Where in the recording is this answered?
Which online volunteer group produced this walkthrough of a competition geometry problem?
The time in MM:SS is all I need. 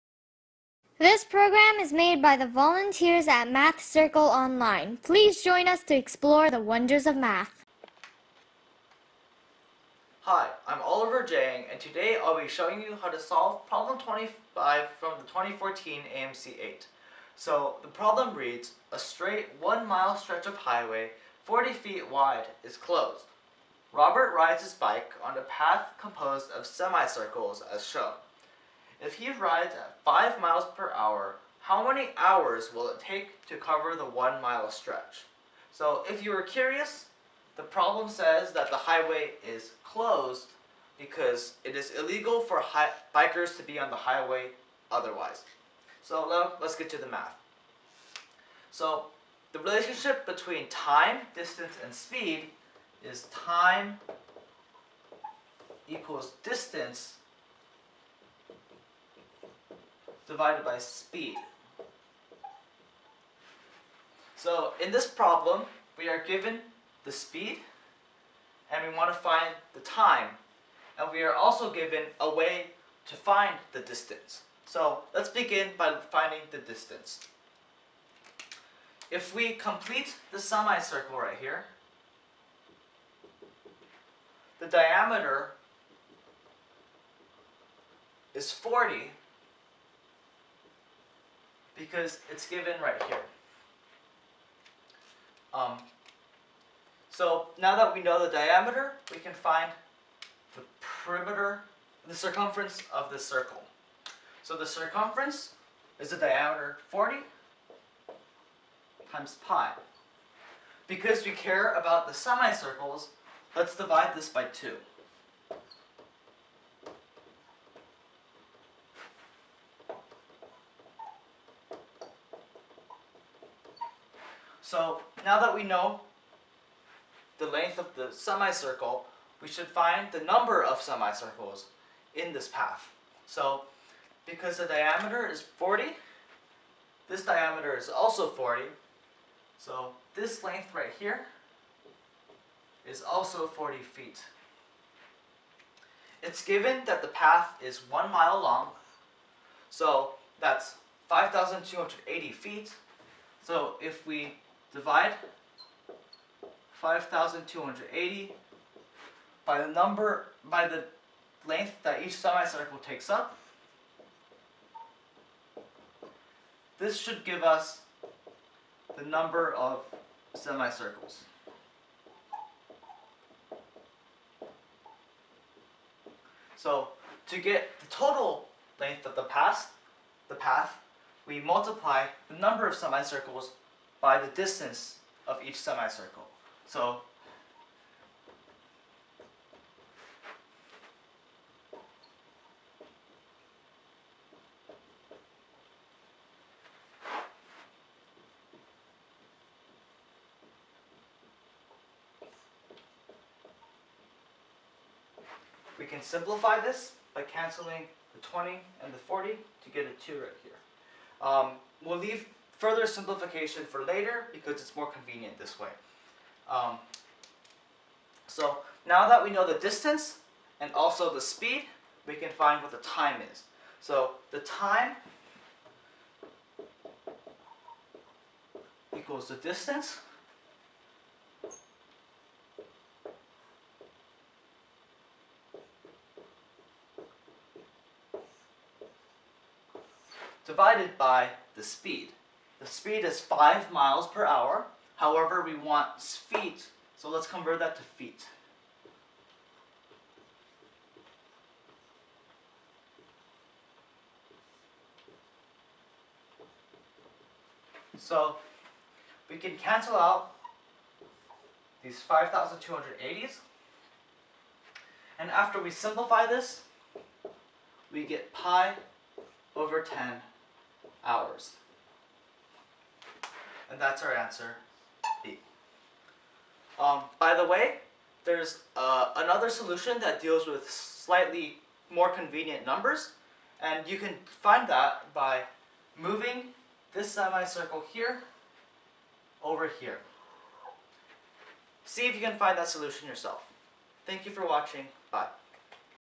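00:03.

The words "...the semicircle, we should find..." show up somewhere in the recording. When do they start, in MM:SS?
02:07.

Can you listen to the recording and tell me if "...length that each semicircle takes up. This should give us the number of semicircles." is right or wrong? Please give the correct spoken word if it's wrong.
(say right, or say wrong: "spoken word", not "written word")
right.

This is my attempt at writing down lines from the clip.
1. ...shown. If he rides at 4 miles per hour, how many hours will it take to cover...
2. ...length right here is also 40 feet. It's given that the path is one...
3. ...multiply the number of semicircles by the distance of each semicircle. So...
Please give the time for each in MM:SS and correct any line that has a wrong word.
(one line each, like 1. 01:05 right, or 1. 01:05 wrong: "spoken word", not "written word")
1. 00:27 wrong: "5", not "4"
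2. 02:20 right
3. 03:01 right.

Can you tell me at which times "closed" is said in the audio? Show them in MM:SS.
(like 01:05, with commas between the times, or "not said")
00:22, 00:39.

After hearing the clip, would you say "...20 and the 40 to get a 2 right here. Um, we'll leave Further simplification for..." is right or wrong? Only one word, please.
right.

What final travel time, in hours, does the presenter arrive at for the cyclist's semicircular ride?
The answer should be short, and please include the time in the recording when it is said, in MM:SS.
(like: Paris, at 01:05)
pi/10, at 04:28.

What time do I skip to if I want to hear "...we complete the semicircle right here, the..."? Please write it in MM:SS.
01:19.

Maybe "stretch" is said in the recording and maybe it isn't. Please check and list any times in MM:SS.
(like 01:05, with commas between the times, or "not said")
00:20, 00:34.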